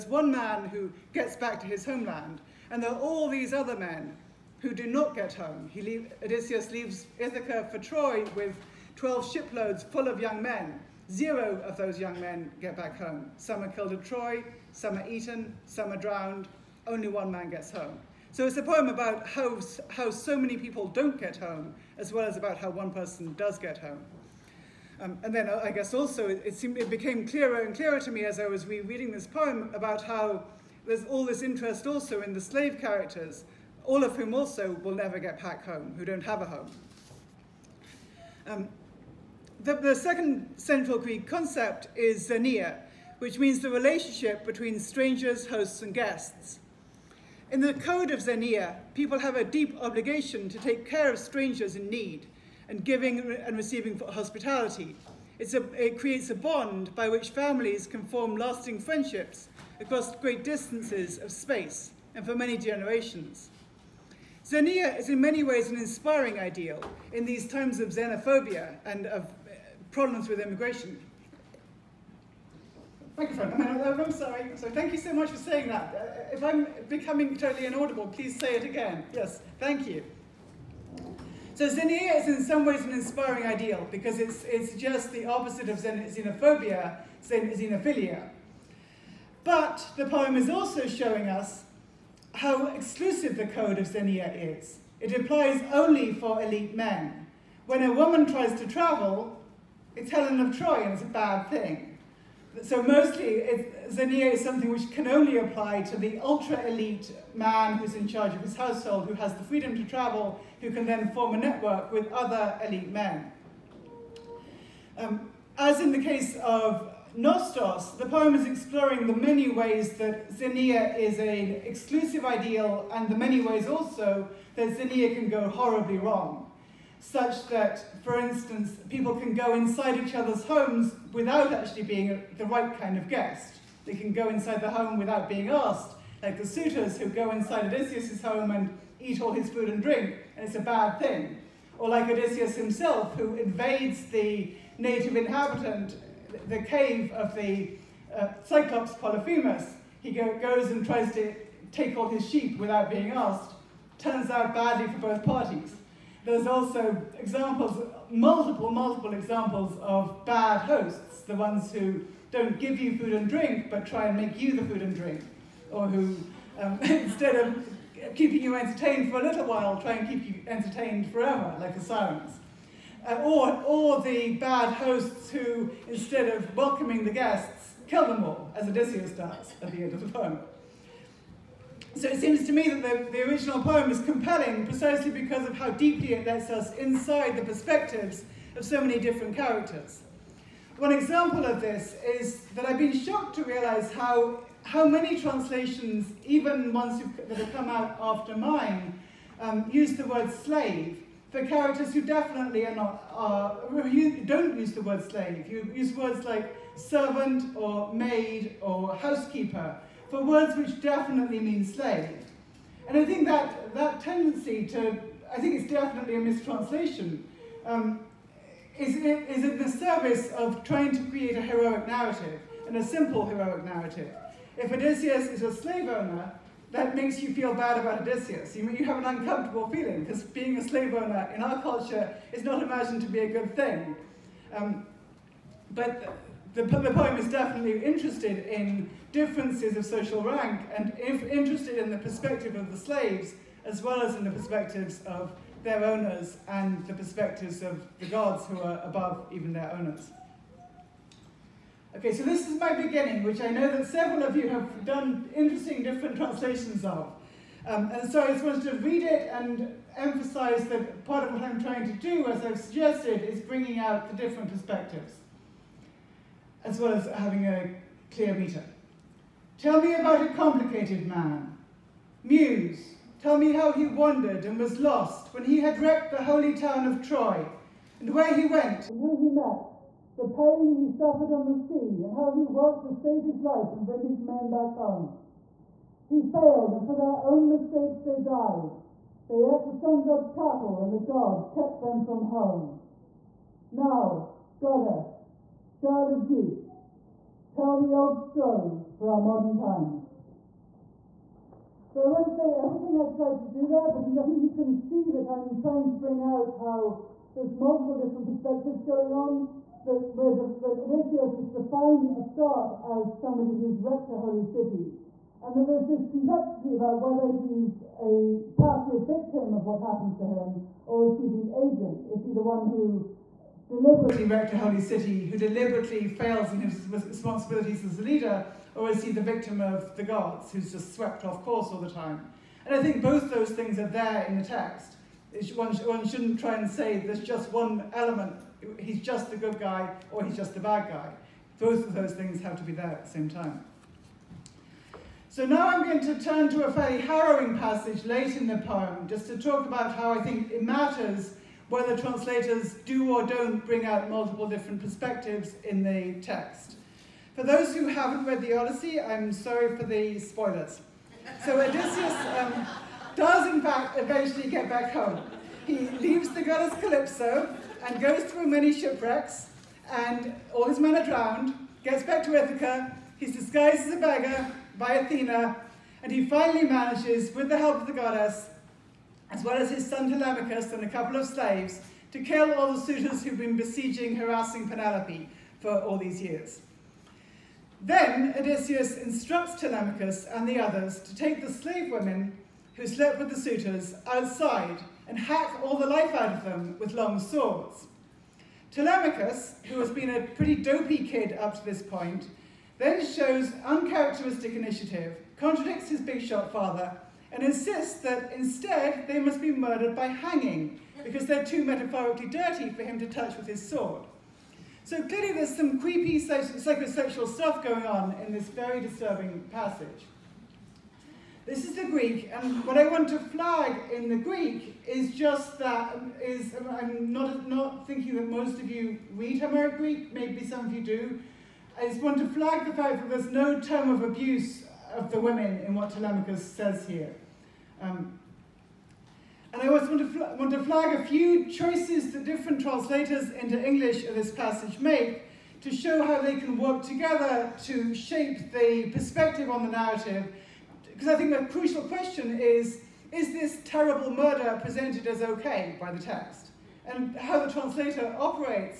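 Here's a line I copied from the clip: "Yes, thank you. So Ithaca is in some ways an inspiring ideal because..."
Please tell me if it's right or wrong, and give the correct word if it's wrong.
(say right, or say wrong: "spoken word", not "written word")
wrong: "Xenia", not "Ithaca".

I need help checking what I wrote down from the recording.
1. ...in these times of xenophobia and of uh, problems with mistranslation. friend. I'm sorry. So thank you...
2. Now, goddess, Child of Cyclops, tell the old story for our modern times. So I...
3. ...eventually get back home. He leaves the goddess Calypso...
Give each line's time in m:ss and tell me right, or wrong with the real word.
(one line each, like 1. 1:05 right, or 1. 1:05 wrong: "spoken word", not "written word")
1. 1:07 wrong: "immigration", not "mistranslation"
2. 4:53 wrong: "Zeus", not "Cyclops"
3. 6:03 right.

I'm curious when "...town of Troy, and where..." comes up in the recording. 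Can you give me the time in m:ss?
4:36.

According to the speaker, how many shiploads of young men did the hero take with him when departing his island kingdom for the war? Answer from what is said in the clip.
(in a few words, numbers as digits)
12.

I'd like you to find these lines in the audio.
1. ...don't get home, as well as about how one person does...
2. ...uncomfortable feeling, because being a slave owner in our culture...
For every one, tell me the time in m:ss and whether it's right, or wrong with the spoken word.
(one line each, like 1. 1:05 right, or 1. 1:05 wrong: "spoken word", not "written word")
1. 0:20 right
2. 3:49 right.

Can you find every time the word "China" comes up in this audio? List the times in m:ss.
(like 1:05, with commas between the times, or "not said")
not said.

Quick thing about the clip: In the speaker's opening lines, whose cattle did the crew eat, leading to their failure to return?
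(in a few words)
The sun god's.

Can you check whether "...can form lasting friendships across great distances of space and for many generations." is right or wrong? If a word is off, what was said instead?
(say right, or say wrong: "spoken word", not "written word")
right.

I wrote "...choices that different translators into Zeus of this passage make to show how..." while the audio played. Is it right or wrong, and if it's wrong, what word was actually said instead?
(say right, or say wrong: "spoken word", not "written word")
wrong: "English", not "Zeus".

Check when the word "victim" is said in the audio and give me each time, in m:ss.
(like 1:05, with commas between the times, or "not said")
5:19, 5:29.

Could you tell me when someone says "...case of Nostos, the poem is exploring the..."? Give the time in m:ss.
1:56.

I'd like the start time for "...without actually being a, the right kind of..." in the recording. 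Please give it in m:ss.
2:11.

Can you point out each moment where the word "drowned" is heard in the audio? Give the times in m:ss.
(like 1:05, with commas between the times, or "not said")
0:15, 6:11.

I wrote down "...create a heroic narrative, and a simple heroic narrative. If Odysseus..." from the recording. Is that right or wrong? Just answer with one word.
right.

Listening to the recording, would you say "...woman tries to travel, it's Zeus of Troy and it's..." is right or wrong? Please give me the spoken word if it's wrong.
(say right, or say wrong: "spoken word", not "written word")
wrong: "Helen", not "Zeus".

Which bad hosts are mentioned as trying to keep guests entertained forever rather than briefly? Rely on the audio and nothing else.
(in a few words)
The sirens.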